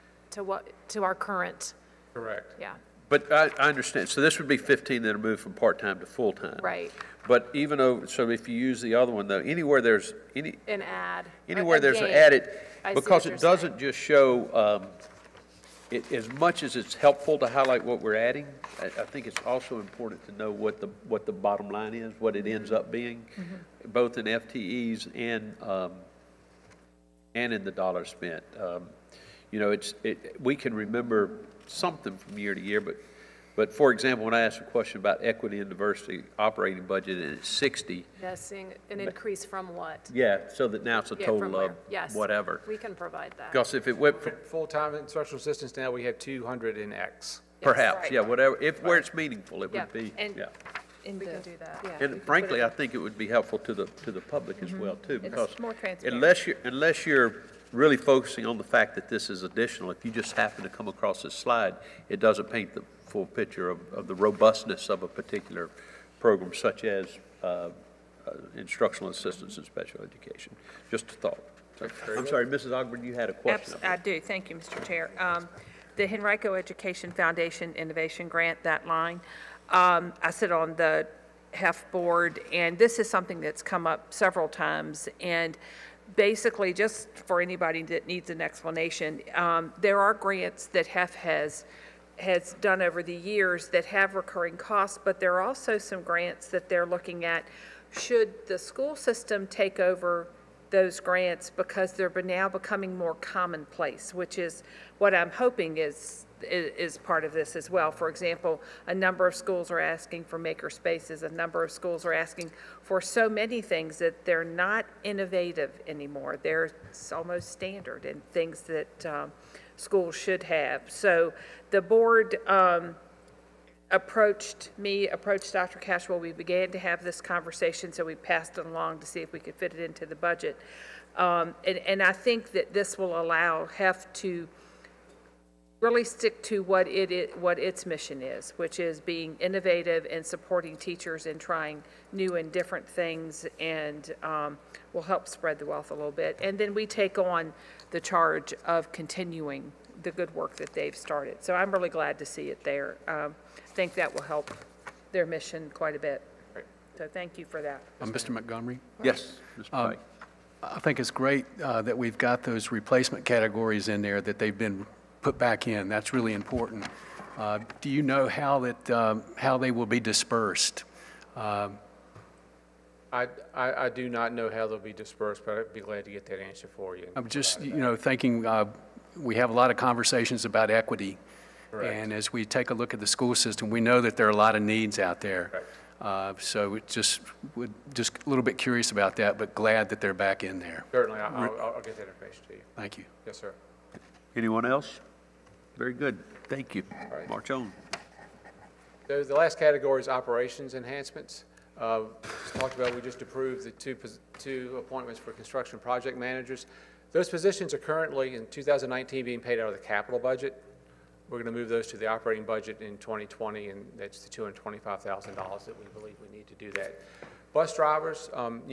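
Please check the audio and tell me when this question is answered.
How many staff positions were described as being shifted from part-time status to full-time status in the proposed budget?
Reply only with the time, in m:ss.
0:04.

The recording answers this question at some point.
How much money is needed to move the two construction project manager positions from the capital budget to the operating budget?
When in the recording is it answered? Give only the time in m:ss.
3:34.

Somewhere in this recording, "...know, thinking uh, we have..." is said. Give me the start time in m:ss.
2:57.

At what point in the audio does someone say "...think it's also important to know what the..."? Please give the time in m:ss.
0:19.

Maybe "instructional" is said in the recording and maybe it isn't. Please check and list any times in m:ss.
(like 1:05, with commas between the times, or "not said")
0:44, 1:08.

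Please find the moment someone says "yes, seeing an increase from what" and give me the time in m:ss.
0:38.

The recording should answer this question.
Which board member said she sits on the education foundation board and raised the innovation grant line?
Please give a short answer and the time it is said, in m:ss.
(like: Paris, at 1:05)
Mrs. Ogburn, at 1:12.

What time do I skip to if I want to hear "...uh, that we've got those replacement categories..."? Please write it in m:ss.
2:41.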